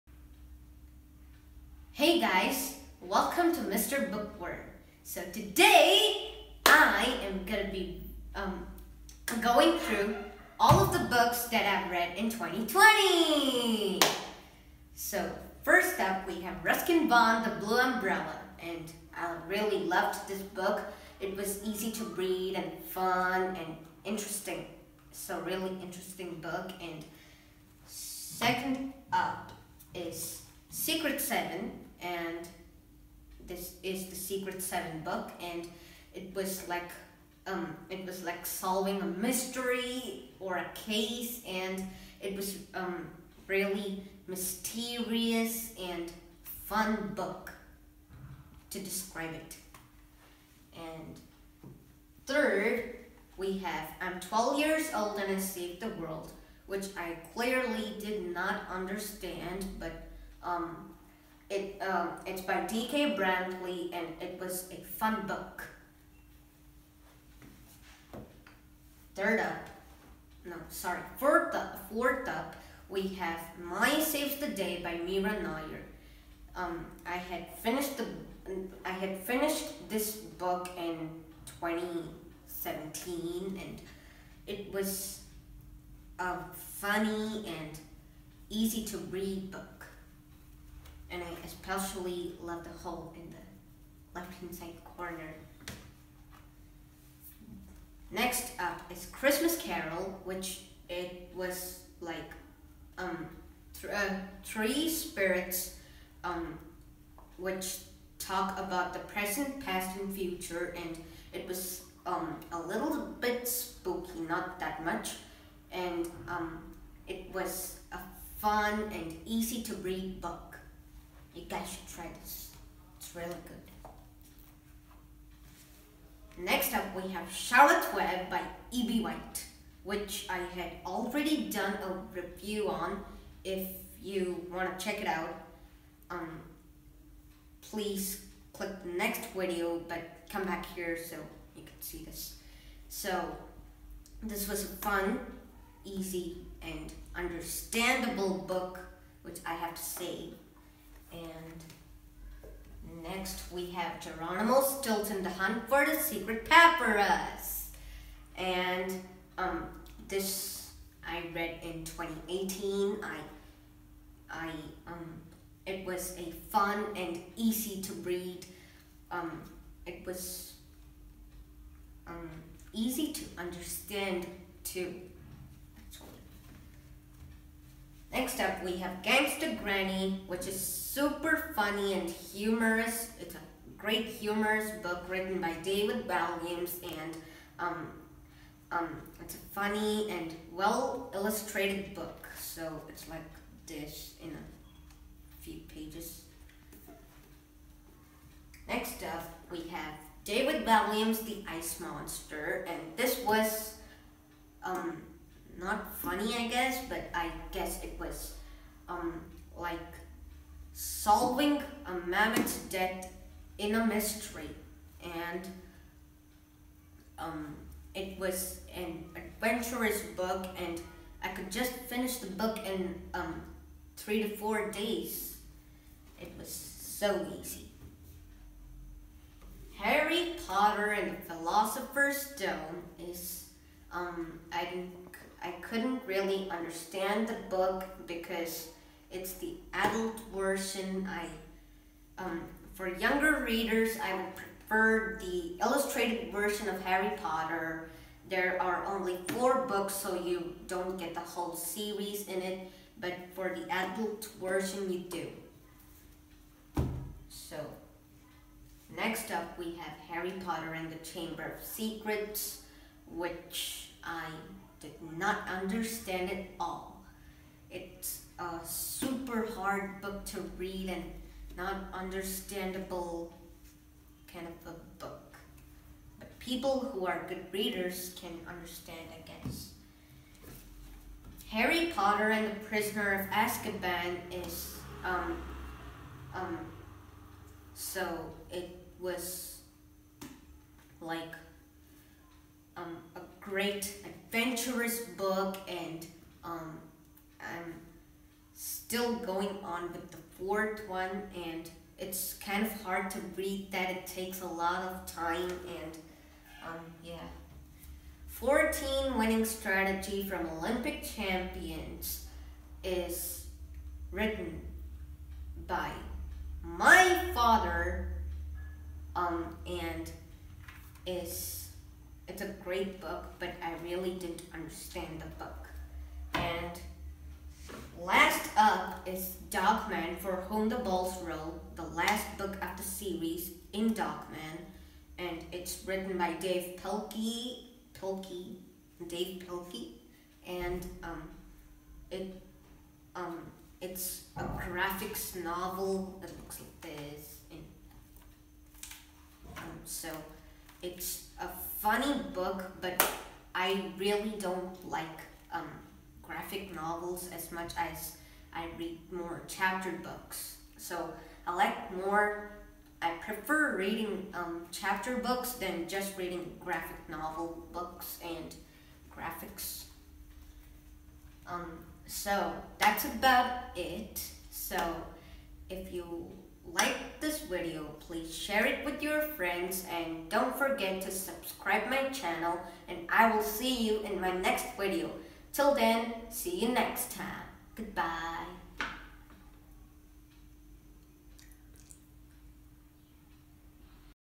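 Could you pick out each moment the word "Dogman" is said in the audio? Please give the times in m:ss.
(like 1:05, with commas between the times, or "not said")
5:29, 5:33.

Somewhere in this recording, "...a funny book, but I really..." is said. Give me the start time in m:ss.
5:51.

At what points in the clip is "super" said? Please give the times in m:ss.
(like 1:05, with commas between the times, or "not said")
3:00, 4:28.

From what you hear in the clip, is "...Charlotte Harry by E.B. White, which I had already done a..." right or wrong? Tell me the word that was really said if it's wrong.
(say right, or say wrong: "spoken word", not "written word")
wrong: "Web", not "Harry".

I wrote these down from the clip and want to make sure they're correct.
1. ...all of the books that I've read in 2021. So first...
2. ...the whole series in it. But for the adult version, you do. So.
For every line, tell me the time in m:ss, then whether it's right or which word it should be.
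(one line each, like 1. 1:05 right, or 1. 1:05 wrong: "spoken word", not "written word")
1. 0:10 wrong: "2020", not "2021"
2. 4:11 right.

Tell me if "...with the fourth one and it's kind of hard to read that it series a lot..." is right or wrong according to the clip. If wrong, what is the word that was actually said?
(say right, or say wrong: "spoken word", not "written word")
wrong: "takes", not "series".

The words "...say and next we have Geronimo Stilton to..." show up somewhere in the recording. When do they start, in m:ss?
2:29.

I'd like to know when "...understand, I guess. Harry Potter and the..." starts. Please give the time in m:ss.
4:38.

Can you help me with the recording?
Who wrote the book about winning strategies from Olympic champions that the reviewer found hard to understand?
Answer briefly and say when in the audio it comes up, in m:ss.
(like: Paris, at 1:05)
my father, at 5:16.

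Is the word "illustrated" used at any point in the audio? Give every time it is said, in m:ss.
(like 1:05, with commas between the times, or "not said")
3:11, 4:05.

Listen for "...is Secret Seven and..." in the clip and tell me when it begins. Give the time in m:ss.
0:29.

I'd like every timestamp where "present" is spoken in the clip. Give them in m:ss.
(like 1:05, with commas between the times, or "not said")
1:49.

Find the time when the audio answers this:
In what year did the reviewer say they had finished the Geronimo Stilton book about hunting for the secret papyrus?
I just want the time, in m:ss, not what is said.
2:41.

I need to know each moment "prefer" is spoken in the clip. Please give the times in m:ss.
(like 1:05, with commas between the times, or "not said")
4:04, 6:03.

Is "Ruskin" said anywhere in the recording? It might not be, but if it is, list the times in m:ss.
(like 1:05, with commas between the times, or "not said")
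0:16.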